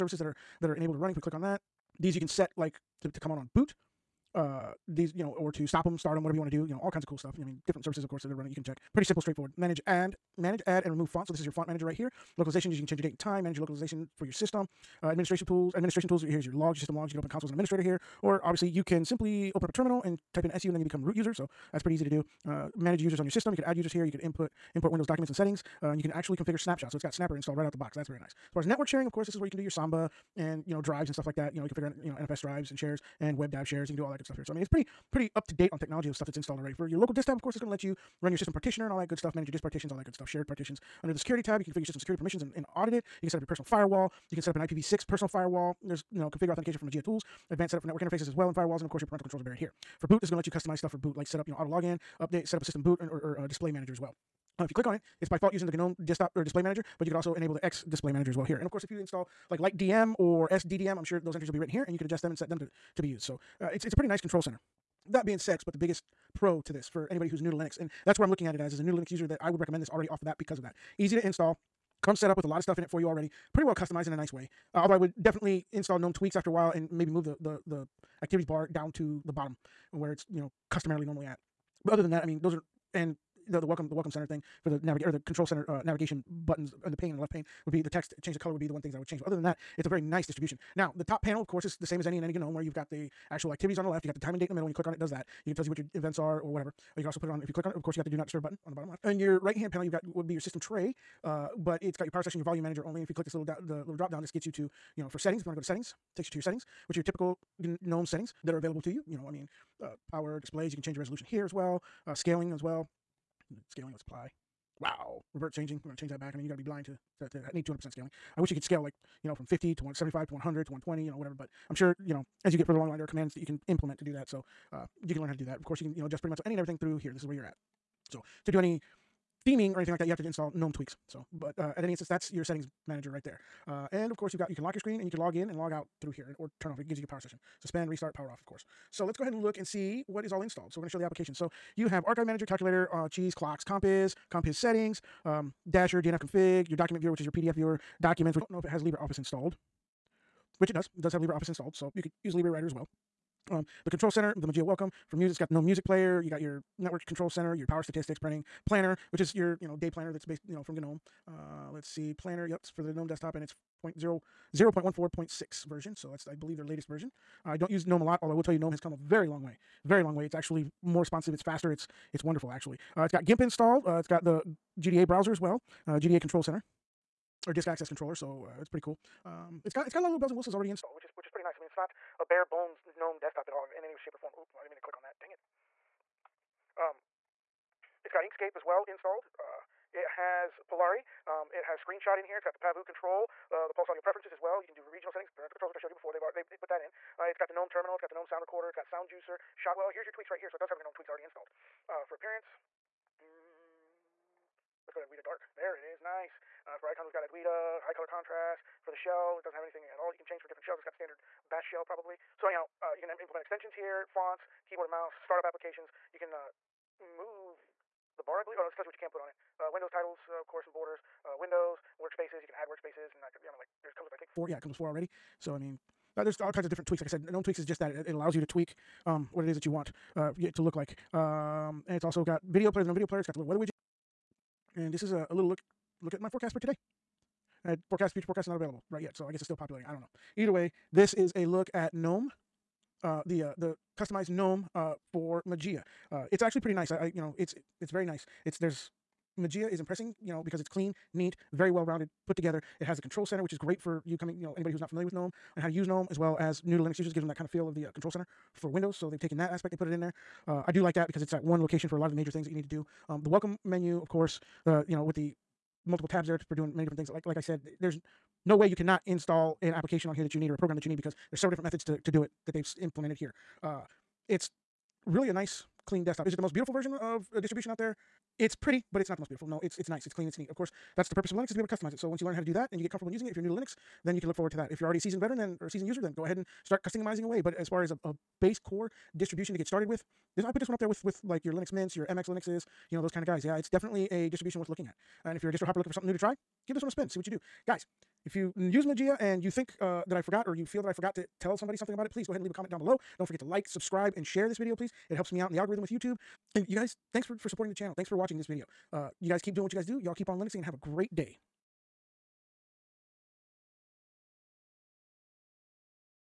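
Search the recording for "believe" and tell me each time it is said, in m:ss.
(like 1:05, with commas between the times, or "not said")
2:46, 3:38.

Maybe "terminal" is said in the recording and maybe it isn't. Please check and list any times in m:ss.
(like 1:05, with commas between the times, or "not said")
0:19, 3:17.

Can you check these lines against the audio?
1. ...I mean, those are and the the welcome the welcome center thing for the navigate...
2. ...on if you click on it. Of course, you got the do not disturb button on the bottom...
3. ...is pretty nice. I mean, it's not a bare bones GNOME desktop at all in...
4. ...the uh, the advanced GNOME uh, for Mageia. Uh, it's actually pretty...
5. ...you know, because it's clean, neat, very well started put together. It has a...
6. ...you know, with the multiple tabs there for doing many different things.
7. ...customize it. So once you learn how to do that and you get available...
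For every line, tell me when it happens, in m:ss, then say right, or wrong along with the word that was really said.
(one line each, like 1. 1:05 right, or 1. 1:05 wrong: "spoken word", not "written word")
1. 1:22 right
2. 1:37 right
3. 3:01 right
4. 4:03 wrong: "customized", not "advanced"
5. 4:10 wrong: "rounded", not "started"
6. 4:24 right
7. 4:41 wrong: "comfortable", not "available".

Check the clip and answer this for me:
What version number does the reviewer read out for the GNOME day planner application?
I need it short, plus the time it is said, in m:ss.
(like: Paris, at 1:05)
0.14.6, at 2:44.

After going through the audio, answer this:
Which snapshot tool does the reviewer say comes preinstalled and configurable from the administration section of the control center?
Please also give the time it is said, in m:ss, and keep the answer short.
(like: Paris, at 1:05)
Snapper, at 0:27.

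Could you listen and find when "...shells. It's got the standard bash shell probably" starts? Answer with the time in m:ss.
3:30.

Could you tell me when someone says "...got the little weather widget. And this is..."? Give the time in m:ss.
3:53.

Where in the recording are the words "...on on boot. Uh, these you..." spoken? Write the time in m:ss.
0:03.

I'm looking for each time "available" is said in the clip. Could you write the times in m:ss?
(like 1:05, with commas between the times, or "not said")
1:48, 3:58.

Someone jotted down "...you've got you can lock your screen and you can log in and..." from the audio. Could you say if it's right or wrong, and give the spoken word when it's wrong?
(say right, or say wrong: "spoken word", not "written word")
right.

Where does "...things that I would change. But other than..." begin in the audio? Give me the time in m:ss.
1:28.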